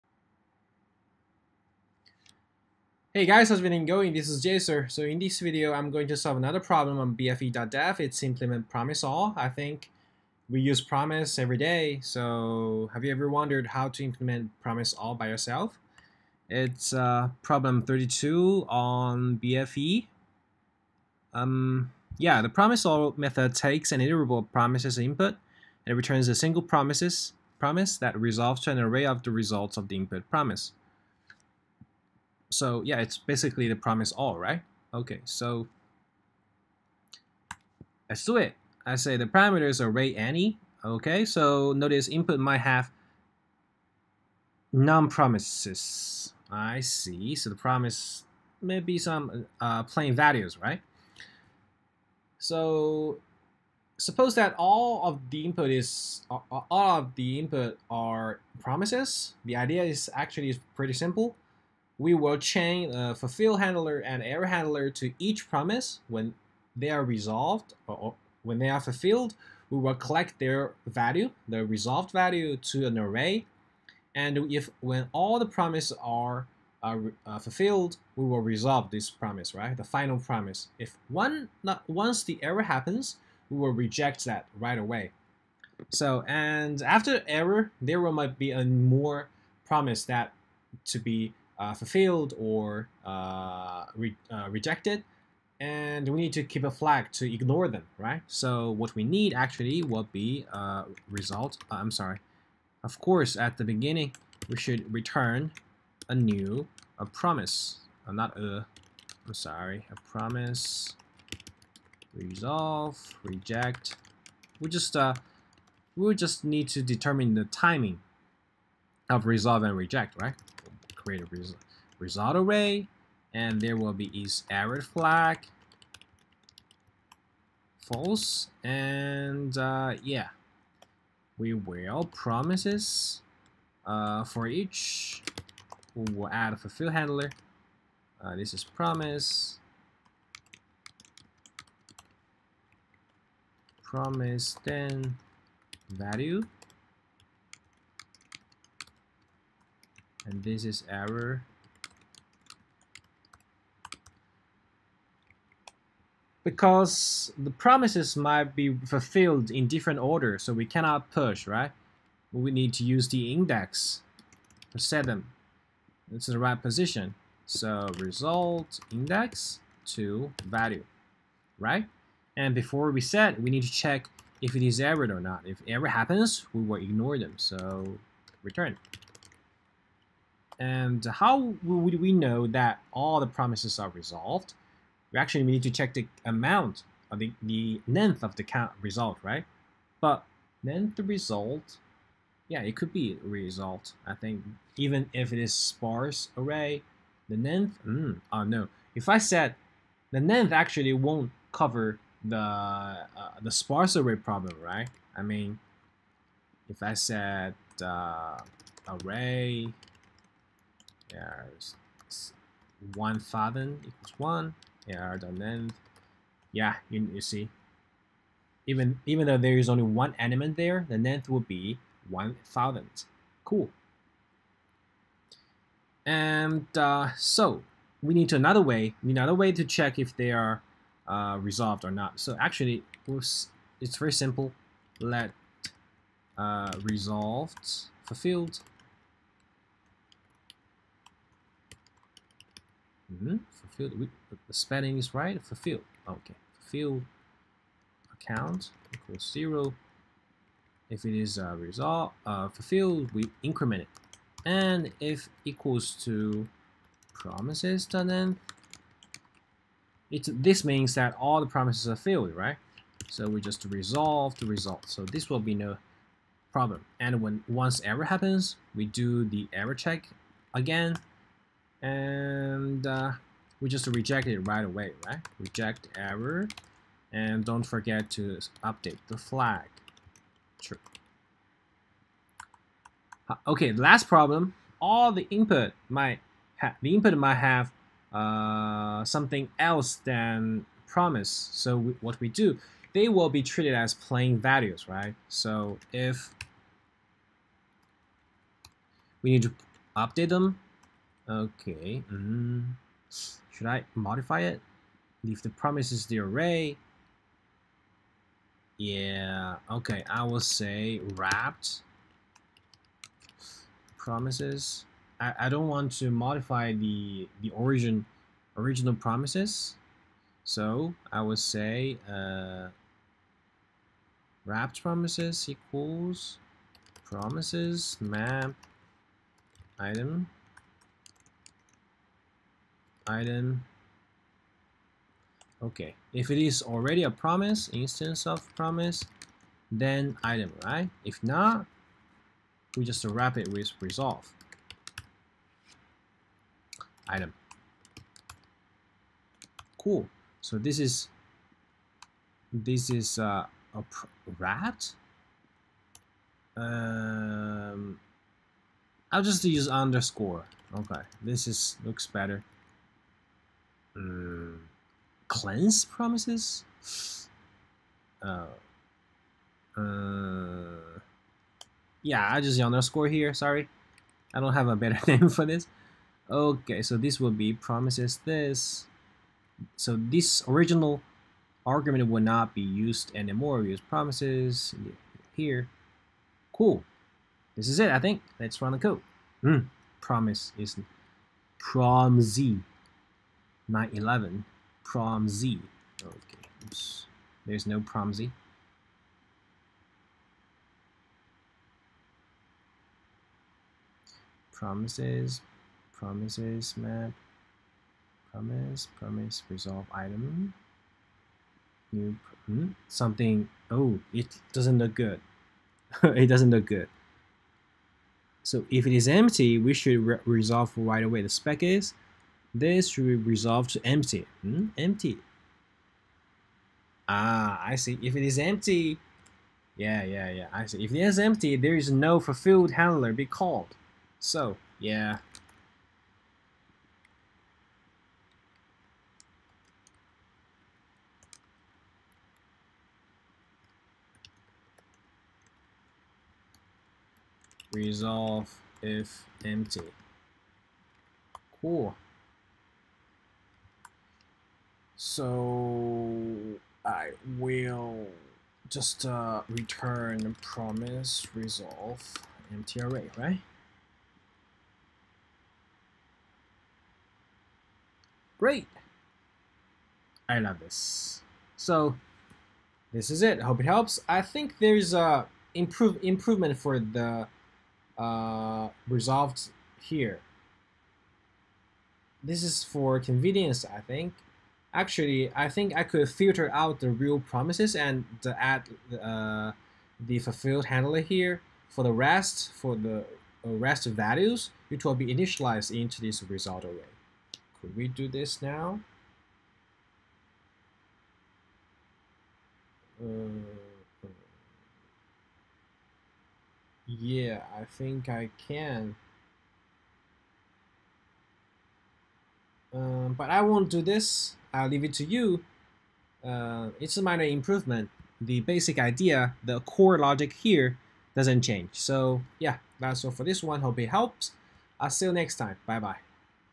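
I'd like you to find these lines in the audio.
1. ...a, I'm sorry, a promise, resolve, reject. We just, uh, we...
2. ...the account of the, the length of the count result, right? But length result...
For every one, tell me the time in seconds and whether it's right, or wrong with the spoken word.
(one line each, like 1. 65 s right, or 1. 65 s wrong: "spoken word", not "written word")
1. 108 s right
2. 185 s wrong: "amount", not "account".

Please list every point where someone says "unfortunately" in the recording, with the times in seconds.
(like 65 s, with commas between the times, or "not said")
not said.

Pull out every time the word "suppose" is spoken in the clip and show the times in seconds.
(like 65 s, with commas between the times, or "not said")
53 s.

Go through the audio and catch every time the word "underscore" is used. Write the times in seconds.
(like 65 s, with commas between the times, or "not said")
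359 s, 372 s.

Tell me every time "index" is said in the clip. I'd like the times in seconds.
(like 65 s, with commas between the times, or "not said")
163 s, 168 s.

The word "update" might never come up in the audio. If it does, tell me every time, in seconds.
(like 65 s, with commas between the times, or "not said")
278 s, 299 s.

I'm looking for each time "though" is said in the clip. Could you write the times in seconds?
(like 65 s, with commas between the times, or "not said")
219 s.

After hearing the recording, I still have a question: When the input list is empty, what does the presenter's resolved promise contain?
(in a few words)
empty array.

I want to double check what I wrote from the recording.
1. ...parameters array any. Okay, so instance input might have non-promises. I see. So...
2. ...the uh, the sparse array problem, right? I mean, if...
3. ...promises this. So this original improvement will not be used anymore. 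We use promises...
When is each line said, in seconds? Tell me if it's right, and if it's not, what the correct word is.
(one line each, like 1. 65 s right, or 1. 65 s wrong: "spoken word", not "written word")
1. 39 s wrong: "notice", not "instance"
2. 202 s right
3. 377 s wrong: "argument", not "improvement".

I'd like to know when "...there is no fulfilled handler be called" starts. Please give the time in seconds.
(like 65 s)
431 s.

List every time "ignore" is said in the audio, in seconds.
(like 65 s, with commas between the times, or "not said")
97 s, 176 s.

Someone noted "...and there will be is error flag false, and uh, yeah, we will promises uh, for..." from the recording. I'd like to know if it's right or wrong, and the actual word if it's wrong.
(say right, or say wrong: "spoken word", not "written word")
right.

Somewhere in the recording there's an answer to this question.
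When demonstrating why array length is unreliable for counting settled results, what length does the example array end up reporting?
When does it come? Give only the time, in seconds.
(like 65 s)
222 s.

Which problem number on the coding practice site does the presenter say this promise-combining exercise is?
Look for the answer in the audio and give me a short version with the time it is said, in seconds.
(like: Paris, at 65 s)
32, at 17 s.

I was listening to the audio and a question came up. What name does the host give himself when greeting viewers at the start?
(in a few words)
JSer.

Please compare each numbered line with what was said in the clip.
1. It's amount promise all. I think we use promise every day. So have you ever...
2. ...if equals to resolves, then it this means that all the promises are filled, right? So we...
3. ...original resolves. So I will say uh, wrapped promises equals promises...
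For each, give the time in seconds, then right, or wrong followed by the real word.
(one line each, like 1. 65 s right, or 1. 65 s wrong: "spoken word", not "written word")
1. 7 s wrong: "implement", not "amount"
2. 254 s wrong: "promises", not "resolves"
3. 318 s wrong: "promises", not "resolves".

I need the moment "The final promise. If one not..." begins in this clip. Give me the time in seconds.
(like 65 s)
79 s.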